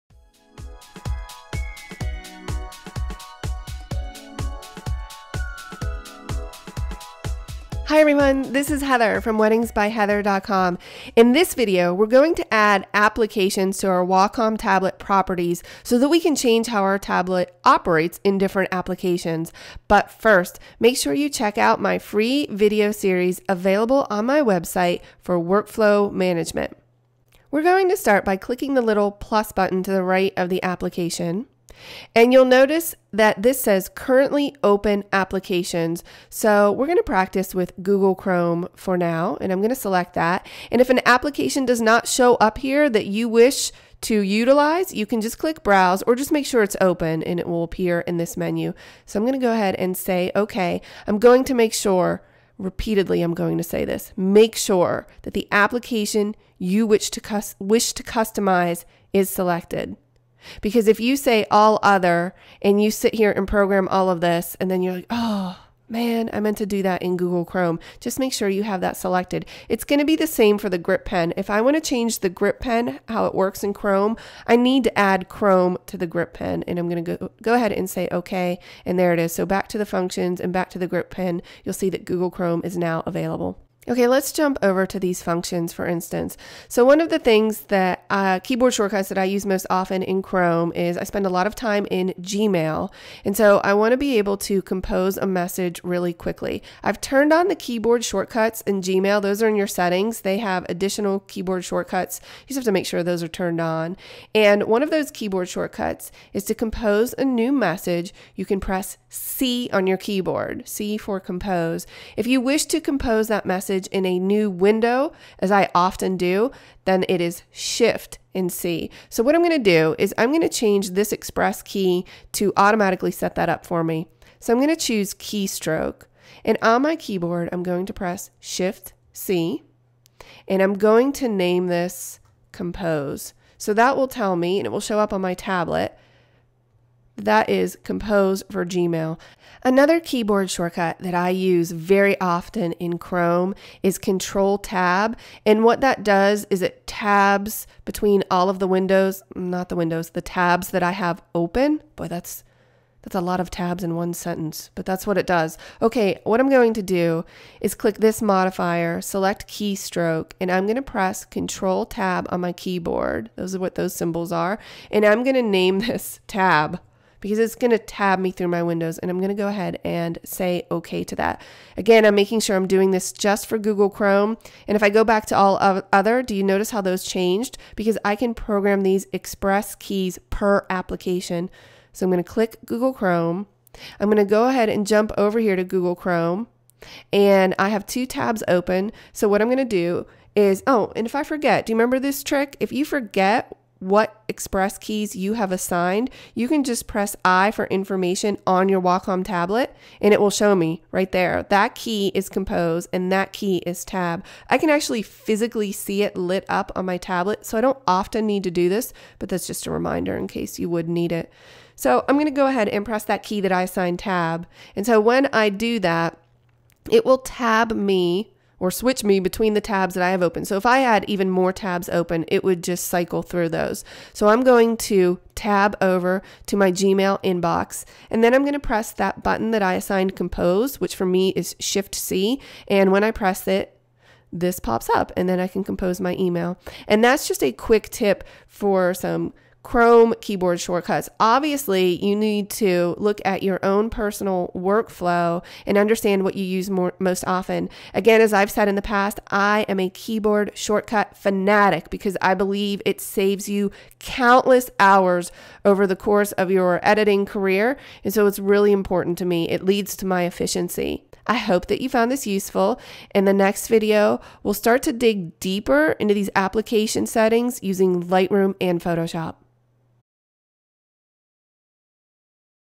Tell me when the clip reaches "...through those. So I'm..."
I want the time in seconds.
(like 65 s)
223 s.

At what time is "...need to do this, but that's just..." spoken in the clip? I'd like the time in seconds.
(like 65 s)
208 s.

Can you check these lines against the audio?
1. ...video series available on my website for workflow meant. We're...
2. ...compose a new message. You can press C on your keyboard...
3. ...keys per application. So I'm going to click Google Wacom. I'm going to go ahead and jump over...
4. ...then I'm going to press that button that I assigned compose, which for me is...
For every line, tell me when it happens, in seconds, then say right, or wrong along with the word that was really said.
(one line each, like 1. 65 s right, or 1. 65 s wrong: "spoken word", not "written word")
1. 22 s wrong: "management", not "meant"
2. 106 s right
3. 179 s wrong: "Chrome", not "Wacom"
4. 228 s right.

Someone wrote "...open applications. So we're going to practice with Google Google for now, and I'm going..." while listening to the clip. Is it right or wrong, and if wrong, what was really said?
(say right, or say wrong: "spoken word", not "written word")
wrong: "Chrome", not "Google".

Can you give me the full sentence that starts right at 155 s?
Okay, what I'm going to do is click this modifier, select keystroke, and I'm going to press Control Tab on my keyboard.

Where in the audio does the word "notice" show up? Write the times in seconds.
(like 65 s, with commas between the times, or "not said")
32 s, 176 s.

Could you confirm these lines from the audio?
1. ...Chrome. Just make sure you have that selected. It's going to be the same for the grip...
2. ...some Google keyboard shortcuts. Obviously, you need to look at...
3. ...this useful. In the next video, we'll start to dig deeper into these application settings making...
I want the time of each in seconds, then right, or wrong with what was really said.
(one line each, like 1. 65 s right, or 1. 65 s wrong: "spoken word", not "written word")
1. 67 s right
2. 238 s wrong: "Chrome", not "Google"
3. 262 s wrong: "using", not "making".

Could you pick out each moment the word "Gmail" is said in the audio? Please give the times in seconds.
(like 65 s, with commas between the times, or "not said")
92 s, 98 s, 138 s, 226 s.